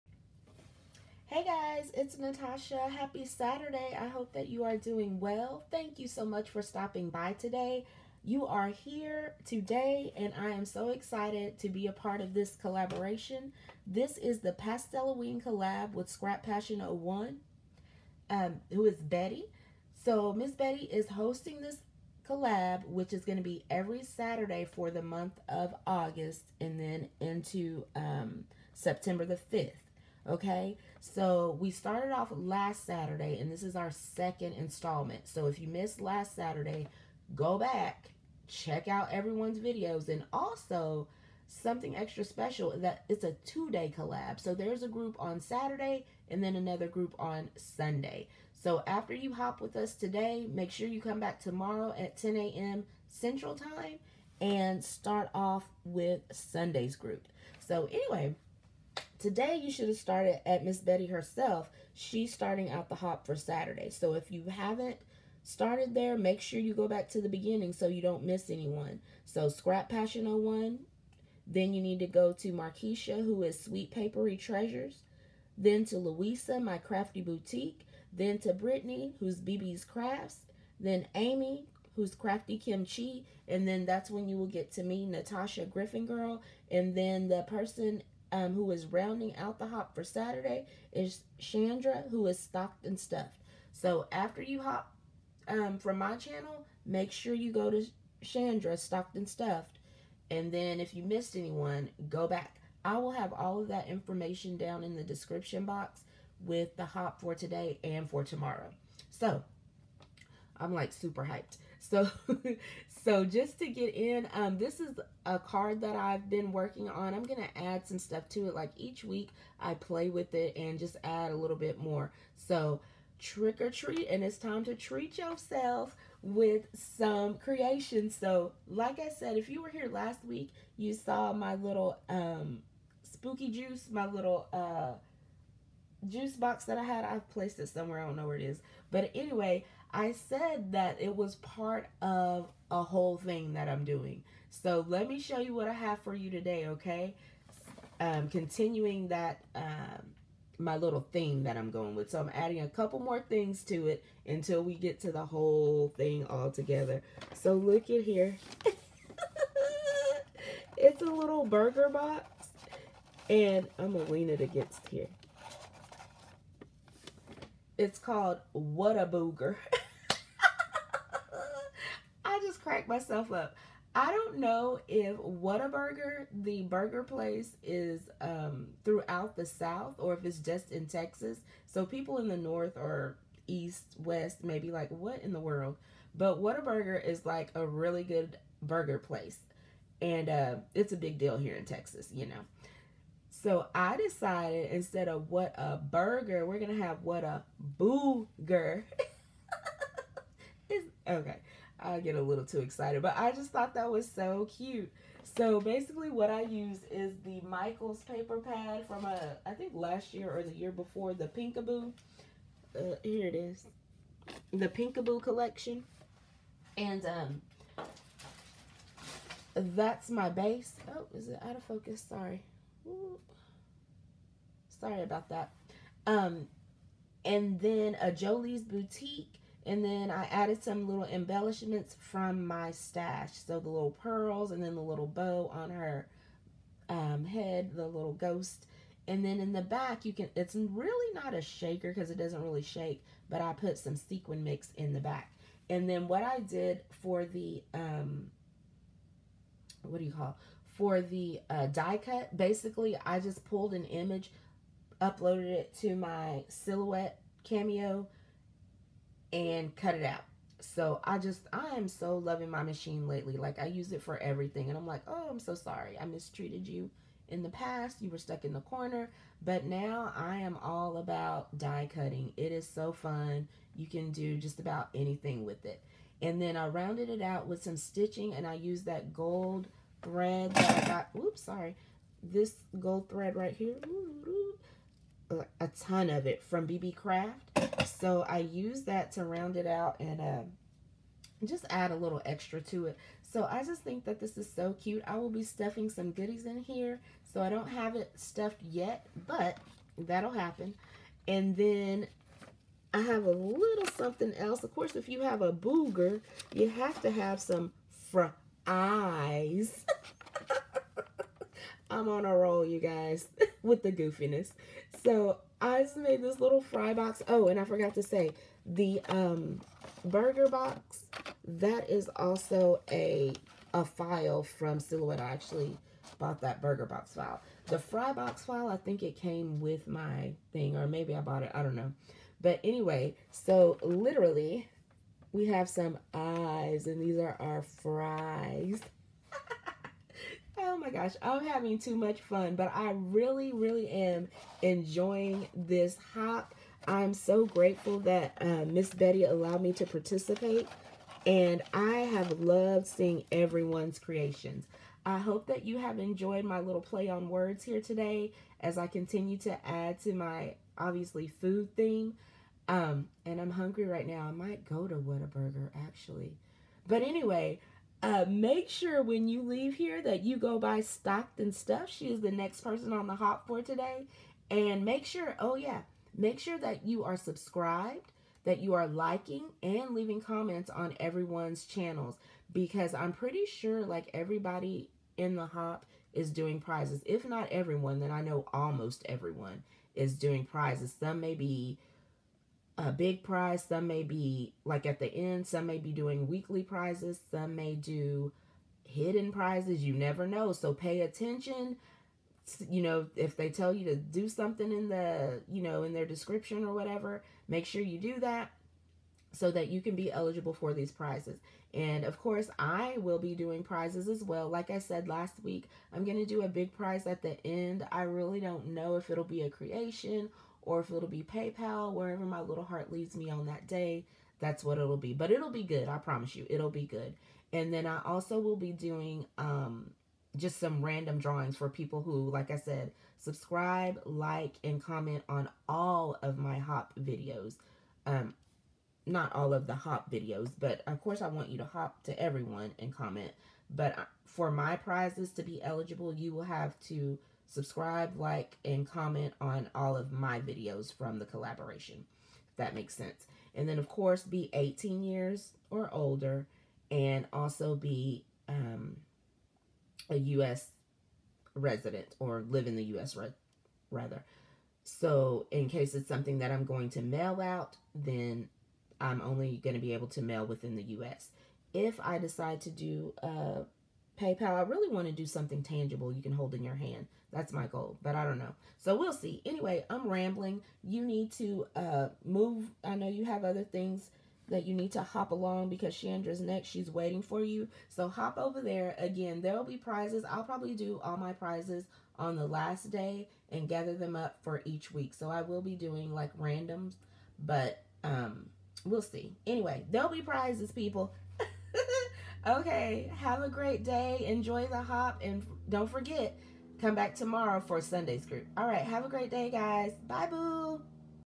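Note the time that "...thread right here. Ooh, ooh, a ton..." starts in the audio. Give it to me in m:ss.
4:43.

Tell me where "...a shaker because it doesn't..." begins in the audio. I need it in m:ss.
4:01.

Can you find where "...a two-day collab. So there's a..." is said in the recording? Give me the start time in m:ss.
0:43.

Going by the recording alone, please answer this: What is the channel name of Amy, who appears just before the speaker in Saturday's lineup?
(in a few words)
Crafty Kimchi.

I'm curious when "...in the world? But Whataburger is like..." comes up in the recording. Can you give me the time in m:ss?
3:05.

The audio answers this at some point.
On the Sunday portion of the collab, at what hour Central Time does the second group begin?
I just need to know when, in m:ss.
0:52.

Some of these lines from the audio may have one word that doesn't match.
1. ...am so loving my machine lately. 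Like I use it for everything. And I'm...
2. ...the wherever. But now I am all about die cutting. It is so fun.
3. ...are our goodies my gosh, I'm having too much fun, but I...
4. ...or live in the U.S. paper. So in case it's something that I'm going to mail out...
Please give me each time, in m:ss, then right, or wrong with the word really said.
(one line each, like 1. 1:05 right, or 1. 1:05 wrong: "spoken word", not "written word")
1. 4:21 right
2. 4:28 wrong: "corner", not "wherever"
3. 5:37 wrong: "fries", not "goodies"
4. 7:42 wrong: "rather", not "paper".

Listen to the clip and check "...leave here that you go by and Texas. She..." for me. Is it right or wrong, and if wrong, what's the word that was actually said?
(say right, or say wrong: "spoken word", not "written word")
wrong: "Stuff", not "Texas".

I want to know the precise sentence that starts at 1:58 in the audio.
Like each week I play with it and just add a little bit more.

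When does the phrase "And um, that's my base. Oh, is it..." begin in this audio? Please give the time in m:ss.
3:36.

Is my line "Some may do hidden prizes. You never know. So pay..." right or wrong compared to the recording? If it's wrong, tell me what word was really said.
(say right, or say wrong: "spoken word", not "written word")
right.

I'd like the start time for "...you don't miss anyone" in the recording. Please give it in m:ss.
1:07.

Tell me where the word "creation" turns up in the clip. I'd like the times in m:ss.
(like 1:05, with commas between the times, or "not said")
2:07, 5:53, 6:59.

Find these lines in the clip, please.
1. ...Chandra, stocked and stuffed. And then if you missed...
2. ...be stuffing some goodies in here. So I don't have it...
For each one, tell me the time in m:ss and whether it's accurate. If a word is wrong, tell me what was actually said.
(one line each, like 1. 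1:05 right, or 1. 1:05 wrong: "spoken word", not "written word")
1. 1:38 right
2. 4:55 right.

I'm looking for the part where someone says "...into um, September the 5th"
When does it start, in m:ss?
0:27.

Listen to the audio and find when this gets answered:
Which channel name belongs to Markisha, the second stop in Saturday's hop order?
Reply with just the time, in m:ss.
1:13.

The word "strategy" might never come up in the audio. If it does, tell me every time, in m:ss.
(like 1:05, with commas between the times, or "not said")
not said.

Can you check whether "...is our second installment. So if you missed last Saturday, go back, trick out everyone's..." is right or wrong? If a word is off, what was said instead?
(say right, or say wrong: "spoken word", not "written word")
wrong: "check", not "trick".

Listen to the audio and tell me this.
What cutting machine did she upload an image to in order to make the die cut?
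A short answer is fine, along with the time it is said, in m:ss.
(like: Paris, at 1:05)
Silhouette Cameo, at 4:16.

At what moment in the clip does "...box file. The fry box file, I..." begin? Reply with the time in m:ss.
5:26.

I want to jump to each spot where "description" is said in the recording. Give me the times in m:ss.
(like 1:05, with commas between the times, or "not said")
1:45, 6:46.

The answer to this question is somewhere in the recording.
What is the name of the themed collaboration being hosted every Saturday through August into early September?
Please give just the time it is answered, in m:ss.
0:14.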